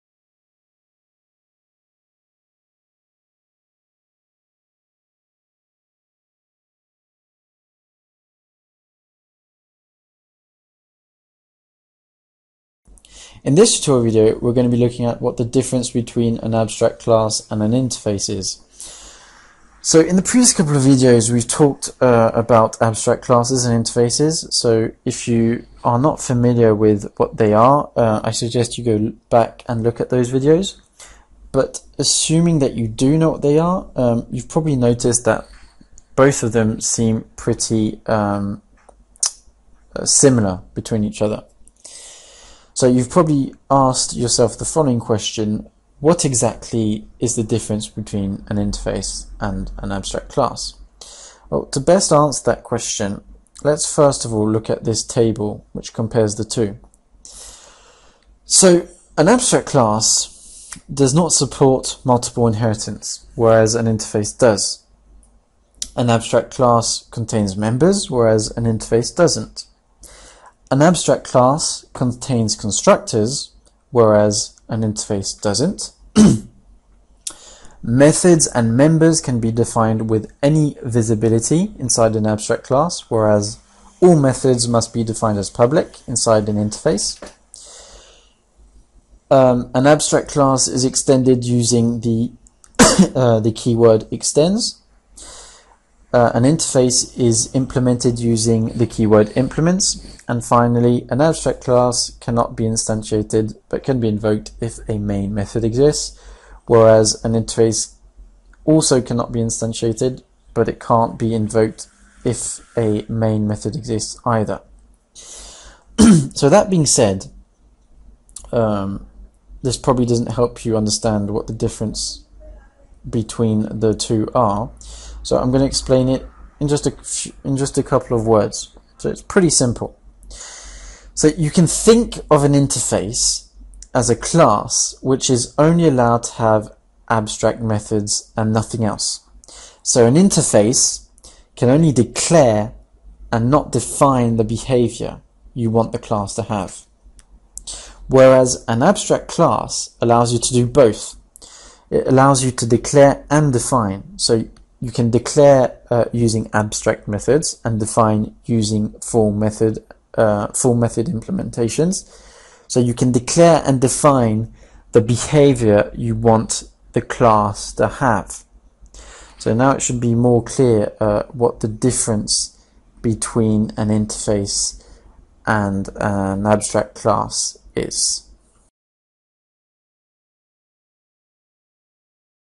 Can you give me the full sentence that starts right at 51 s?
Well, to best answer that question, let's first of all look at this table which compares the two.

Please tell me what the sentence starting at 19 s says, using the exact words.
So in the previous couple of videos, we've talked uh, about abstract classes and interfaces.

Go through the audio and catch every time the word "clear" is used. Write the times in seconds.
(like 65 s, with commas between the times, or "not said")
170 s.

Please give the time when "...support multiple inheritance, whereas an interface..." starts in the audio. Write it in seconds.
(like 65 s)
61 s.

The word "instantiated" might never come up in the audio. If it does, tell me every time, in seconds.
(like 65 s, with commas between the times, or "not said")
102 s, 109 s.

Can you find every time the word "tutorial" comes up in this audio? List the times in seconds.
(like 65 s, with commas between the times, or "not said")
13 s.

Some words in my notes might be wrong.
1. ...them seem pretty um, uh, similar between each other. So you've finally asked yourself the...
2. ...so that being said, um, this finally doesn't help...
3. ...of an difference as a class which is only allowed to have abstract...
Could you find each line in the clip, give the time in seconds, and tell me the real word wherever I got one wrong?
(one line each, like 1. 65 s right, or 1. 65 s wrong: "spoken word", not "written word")
1. 36 s wrong: "probably", not "finally"
2. 115 s wrong: "probably", not "finally"
3. 132 s wrong: "interface", not "difference".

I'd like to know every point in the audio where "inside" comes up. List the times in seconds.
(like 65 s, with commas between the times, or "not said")
81 s, 86 s.